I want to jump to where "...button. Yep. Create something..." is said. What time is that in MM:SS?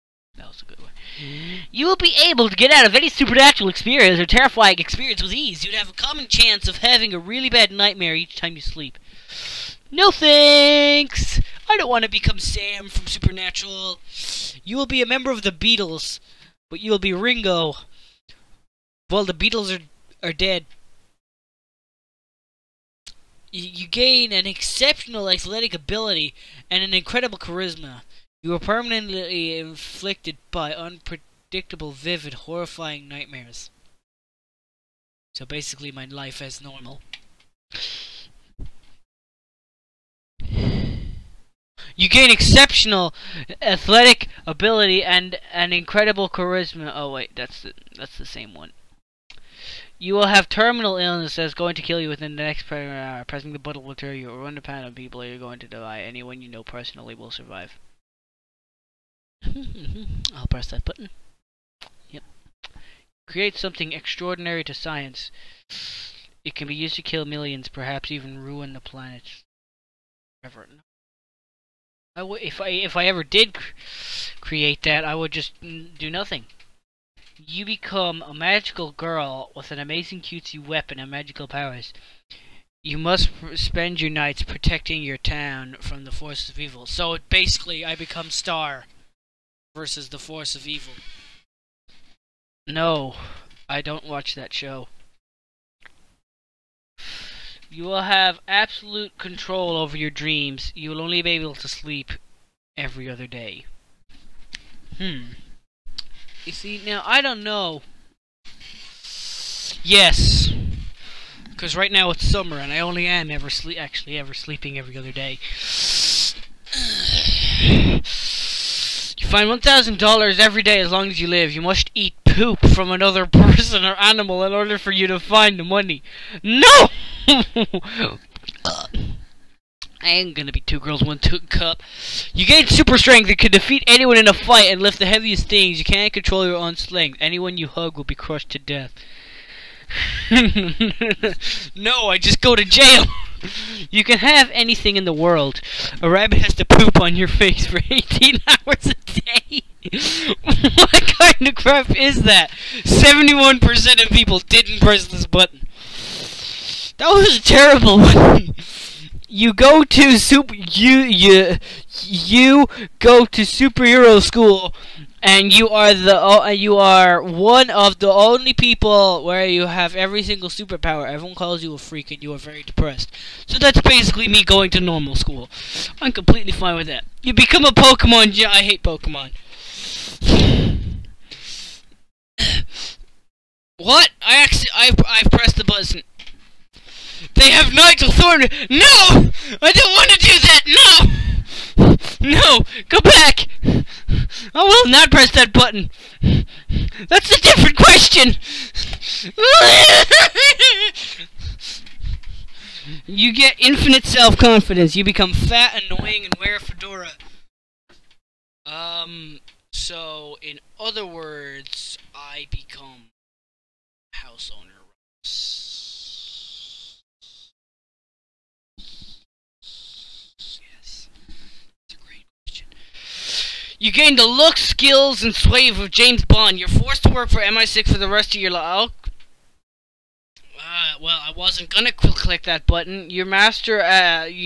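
01:00.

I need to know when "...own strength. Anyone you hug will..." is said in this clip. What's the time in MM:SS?
02:16.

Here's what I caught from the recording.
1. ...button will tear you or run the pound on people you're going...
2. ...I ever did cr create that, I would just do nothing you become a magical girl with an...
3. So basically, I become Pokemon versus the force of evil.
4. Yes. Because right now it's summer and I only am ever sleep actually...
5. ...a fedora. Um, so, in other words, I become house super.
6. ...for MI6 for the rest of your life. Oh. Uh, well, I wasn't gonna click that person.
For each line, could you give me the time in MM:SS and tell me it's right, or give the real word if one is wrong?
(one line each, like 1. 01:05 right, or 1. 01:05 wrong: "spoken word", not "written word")
1. 00:53 right
2. 01:12 right
3. 01:26 wrong: "Star", not "Pokemon"
4. 01:49 right
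5. 03:26 wrong: "owner", not "super"
6. 03:47 wrong: "button", not "person".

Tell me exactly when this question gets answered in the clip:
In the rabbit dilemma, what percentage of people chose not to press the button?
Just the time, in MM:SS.
02:32.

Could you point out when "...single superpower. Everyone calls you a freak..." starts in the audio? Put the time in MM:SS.
02:50.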